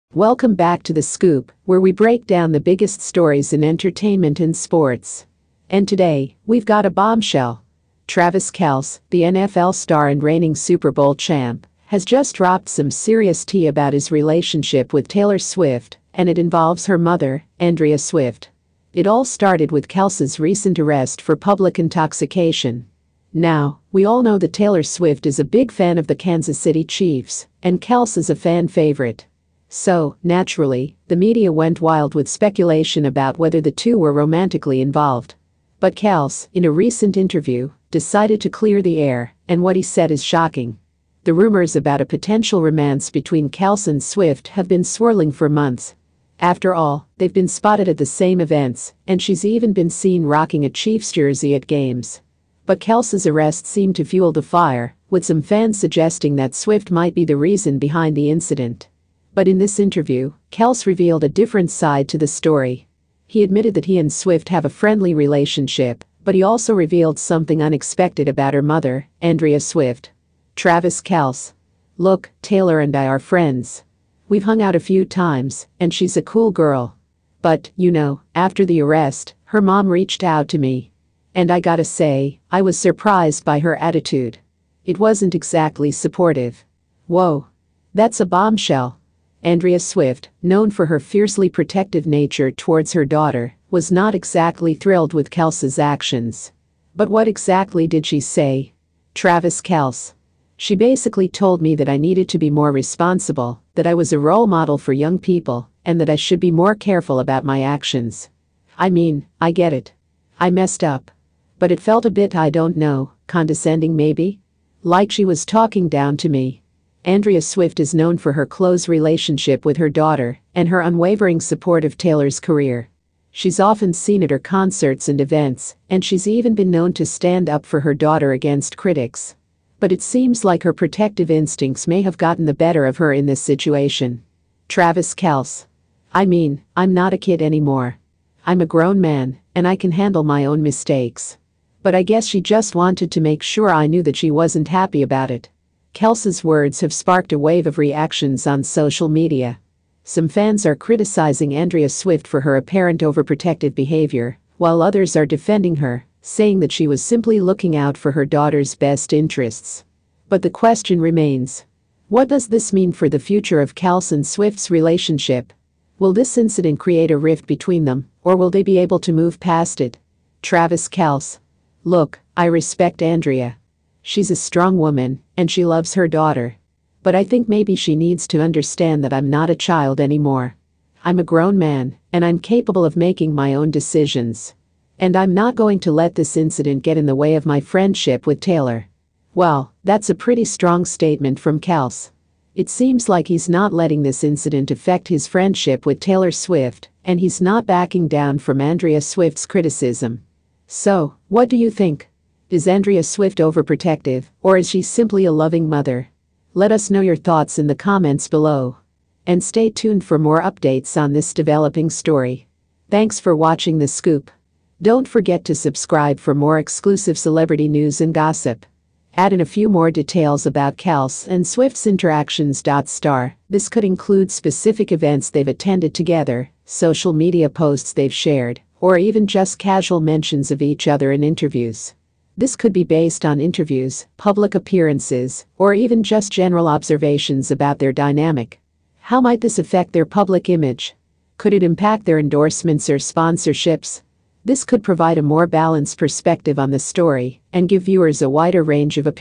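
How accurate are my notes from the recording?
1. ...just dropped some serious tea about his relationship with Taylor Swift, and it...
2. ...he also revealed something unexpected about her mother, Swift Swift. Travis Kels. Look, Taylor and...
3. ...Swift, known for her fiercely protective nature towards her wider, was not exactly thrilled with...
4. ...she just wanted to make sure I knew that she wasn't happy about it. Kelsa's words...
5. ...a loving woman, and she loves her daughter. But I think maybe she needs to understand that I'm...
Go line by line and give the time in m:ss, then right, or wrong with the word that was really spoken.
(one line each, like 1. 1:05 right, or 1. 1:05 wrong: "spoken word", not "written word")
1. 0:12 right
2. 1:06 wrong: "Andrea", not "Swift"
3. 1:29 wrong: "daughter", not "wider"
4. 2:22 right
5. 2:54 wrong: "strong", not "loving".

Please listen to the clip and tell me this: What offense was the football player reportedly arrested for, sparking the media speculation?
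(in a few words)
Public intoxication.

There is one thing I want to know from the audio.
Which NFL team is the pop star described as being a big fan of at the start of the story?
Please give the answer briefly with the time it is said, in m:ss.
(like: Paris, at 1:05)
Kansas City Chiefs, at 0:26.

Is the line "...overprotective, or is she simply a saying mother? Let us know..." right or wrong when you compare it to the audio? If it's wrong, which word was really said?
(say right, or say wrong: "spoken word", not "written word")
wrong: "loving", not "saying".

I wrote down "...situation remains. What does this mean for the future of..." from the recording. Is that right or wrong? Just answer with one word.
wrong.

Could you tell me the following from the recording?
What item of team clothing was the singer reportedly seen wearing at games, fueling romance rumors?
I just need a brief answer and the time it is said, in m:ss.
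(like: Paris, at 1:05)
Chiefs jersey, at 0:50.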